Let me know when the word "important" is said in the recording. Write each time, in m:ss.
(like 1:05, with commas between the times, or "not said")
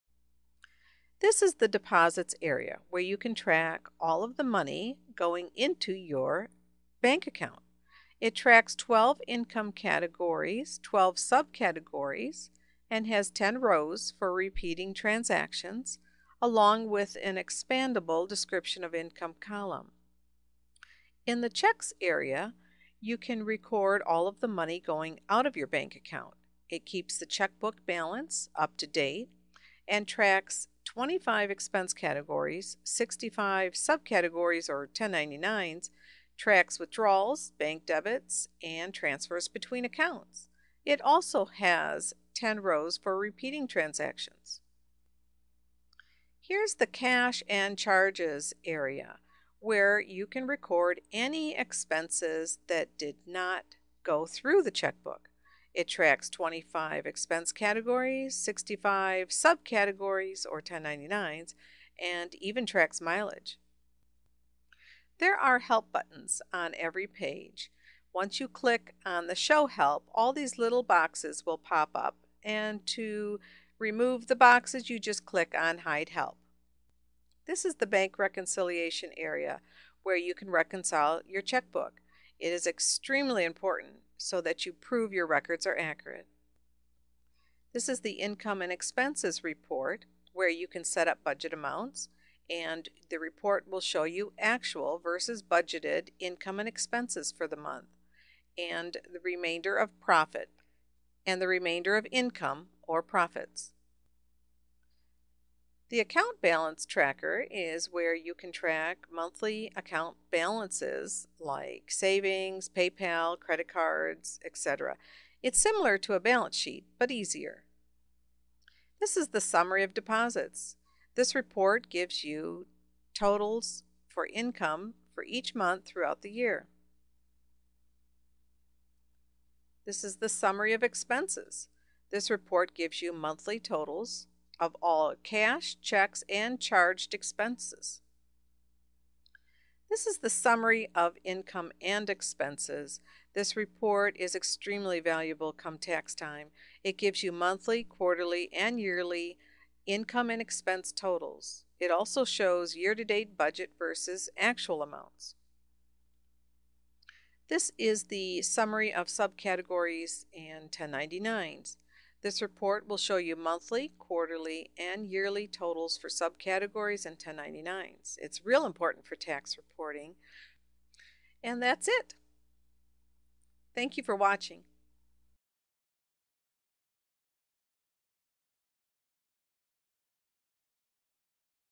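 1:23, 2:48.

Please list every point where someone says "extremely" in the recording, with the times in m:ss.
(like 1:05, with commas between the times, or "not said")
1:22, 2:24.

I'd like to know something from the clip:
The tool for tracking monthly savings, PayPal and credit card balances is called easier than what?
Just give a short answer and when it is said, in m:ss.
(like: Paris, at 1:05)
balance sheet, at 1:56.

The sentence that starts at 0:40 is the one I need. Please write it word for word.
It also has 10 rows for repeating transactions.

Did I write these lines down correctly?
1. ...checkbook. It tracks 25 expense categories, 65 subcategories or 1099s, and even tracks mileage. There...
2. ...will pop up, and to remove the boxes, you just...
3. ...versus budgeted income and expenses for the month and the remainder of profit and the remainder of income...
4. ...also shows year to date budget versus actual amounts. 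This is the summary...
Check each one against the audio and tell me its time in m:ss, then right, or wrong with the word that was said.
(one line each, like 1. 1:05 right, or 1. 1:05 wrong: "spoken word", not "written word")
1. 0:54 right
2. 1:11 right
3. 1:35 right
4. 2:31 right.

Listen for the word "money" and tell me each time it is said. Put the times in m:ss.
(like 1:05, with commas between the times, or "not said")
0:04, 0:24.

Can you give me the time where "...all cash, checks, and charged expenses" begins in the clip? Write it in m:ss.
2:14.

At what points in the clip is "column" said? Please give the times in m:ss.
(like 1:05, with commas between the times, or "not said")
0:19.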